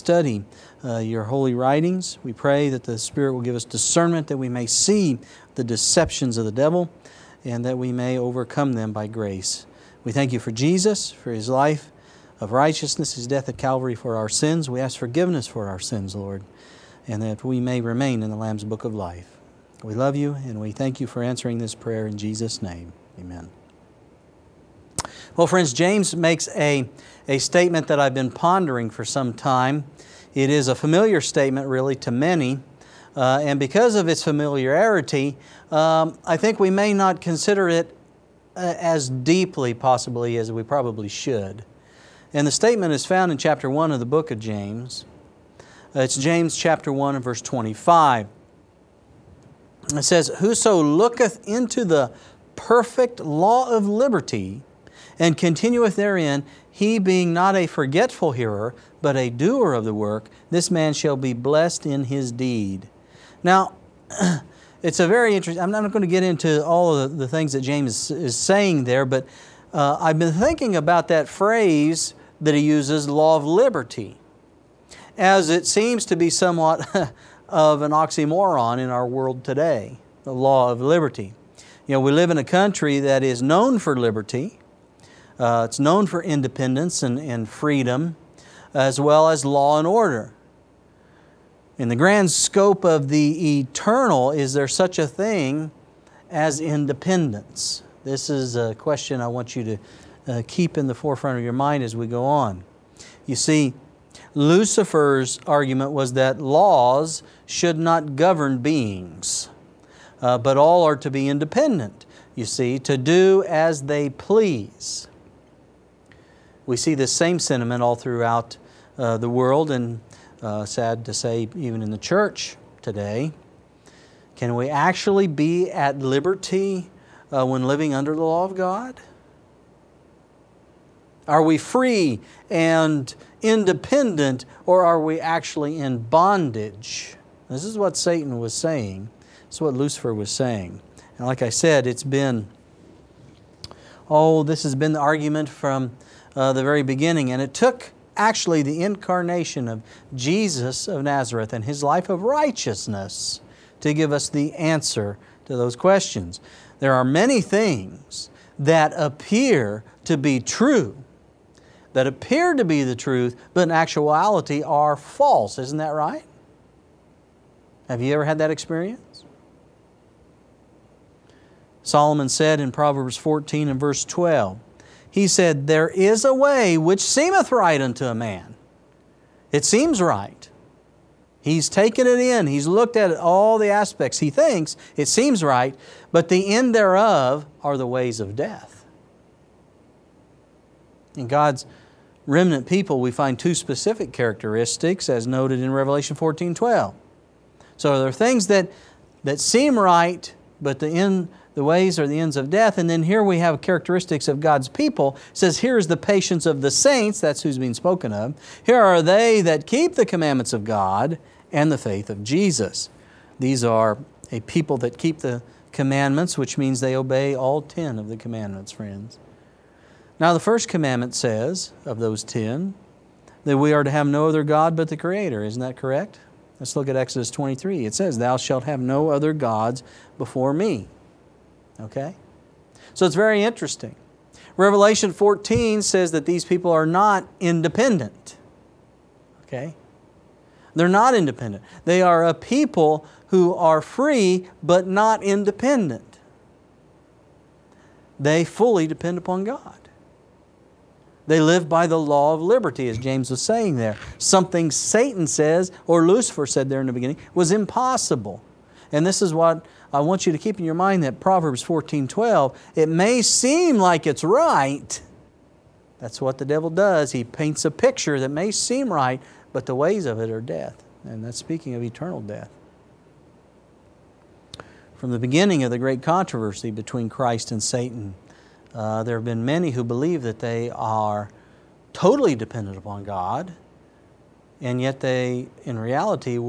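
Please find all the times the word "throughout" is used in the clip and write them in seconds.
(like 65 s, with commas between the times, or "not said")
117 s.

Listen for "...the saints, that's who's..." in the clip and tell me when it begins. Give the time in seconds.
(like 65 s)
206 s.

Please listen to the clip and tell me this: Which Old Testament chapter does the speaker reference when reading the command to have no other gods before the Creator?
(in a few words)
Exodus 23.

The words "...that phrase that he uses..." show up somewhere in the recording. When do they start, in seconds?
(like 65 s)
71 s.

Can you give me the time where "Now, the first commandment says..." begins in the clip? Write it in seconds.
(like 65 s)
220 s.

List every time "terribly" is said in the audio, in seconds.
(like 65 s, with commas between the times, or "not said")
not said.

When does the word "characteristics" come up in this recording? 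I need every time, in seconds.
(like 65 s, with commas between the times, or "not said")
194 s, 203 s.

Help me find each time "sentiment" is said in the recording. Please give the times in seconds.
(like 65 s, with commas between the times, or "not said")
117 s.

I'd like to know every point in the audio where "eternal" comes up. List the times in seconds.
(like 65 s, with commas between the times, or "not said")
93 s, 271 s.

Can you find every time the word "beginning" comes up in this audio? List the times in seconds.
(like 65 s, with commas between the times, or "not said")
146 s, 256 s, 275 s.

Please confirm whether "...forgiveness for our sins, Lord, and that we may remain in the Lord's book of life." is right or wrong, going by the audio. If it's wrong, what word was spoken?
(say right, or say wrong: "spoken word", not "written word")
wrong: "Lamb", not "Lord".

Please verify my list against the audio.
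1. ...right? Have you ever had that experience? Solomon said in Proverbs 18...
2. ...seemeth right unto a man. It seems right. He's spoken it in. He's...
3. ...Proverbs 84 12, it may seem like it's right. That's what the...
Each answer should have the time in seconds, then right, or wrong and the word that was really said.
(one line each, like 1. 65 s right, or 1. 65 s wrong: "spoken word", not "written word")
1. 165 s wrong: "14", not "18"
2. 177 s wrong: "taken", not "spoken"
3. 261 s wrong: "14", not "84".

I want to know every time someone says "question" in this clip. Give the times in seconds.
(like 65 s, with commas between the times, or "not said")
98 s, 155 s.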